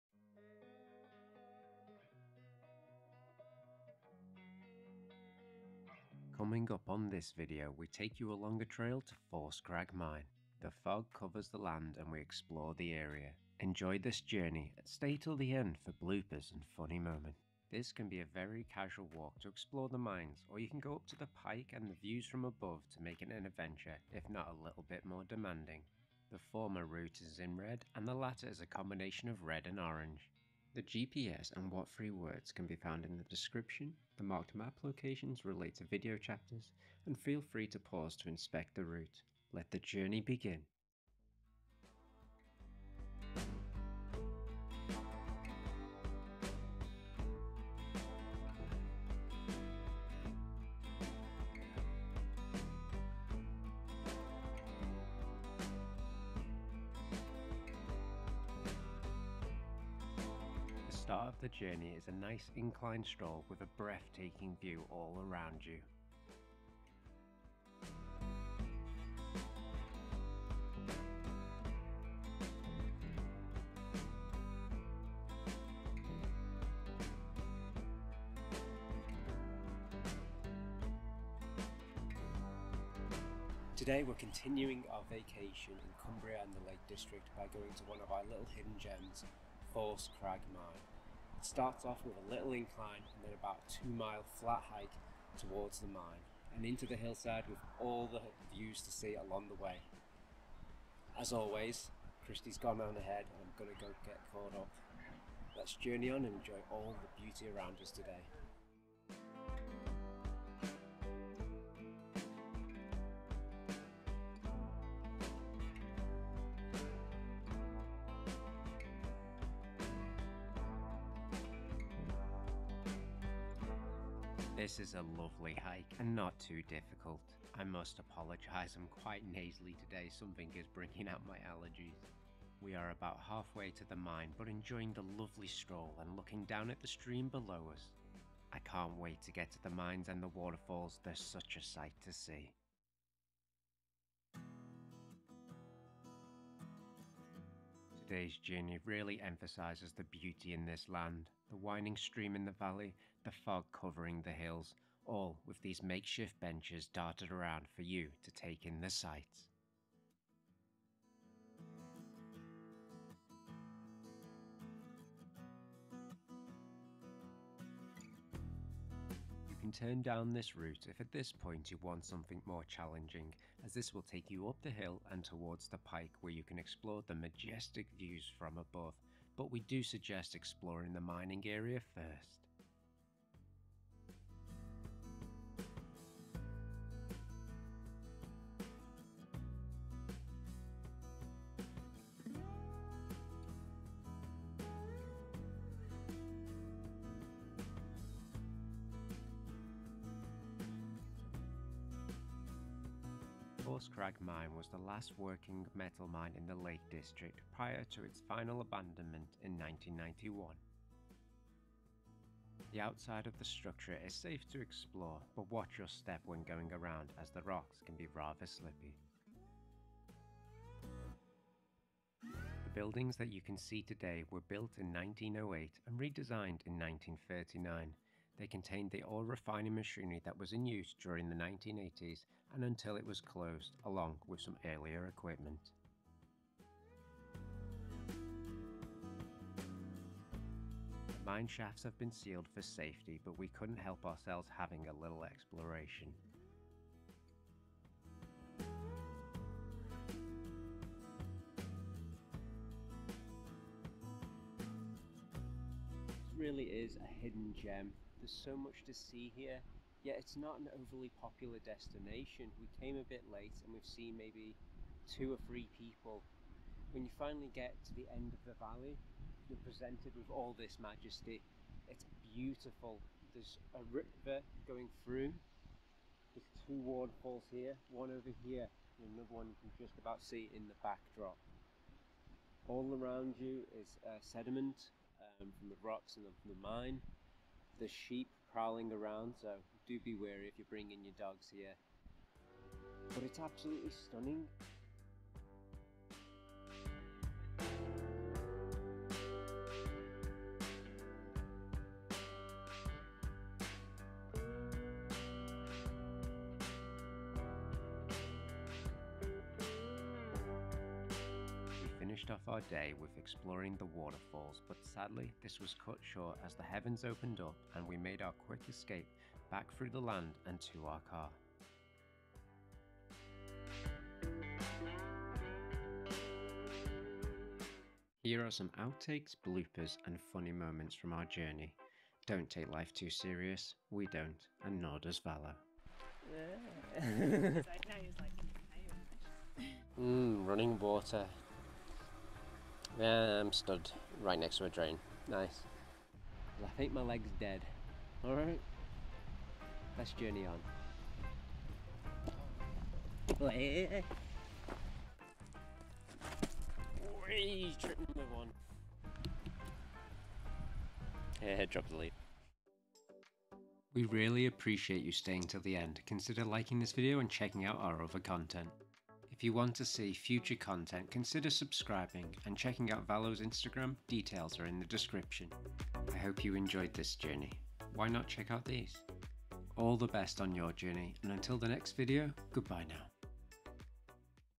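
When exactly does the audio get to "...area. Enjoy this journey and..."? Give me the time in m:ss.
0:12.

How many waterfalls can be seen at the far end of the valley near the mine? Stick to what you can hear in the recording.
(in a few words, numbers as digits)
2.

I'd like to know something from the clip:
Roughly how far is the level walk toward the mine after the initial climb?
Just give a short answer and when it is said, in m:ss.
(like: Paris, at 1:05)
2 miles, at 1:33.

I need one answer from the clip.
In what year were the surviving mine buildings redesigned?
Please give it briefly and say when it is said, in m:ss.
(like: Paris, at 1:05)
1939, at 3:46.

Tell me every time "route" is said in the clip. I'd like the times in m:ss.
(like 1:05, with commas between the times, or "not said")
0:26, 0:38, 2:50.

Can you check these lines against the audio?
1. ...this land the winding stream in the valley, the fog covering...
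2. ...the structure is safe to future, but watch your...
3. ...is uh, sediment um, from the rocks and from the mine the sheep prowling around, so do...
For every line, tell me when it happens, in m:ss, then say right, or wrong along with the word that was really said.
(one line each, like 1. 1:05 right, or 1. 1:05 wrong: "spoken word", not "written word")
1. 2:30 right
2. 3:33 wrong: "explore", not "future"
3. 4:43 right.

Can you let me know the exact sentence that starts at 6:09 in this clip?
If you want to see future content, consider subscribing and checking out Valo's Instagram.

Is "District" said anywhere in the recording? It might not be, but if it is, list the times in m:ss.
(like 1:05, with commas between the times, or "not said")
1:26, 3:26.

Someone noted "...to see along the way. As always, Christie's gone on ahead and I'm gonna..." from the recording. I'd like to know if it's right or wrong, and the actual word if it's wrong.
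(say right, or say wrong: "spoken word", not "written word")
right.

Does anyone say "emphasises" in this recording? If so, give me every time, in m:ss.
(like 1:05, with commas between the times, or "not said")
2:29.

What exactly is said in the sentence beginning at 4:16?
really is a hidden gem there's so much to see here.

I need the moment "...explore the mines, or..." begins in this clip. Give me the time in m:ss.
0:19.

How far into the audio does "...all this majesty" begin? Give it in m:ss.
4:30.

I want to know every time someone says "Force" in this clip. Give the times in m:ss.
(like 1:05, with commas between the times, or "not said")
0:09, 1:29, 3:23.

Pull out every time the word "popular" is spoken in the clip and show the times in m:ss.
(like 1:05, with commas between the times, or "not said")
4:21.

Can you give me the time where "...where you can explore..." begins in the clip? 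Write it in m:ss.
2:56.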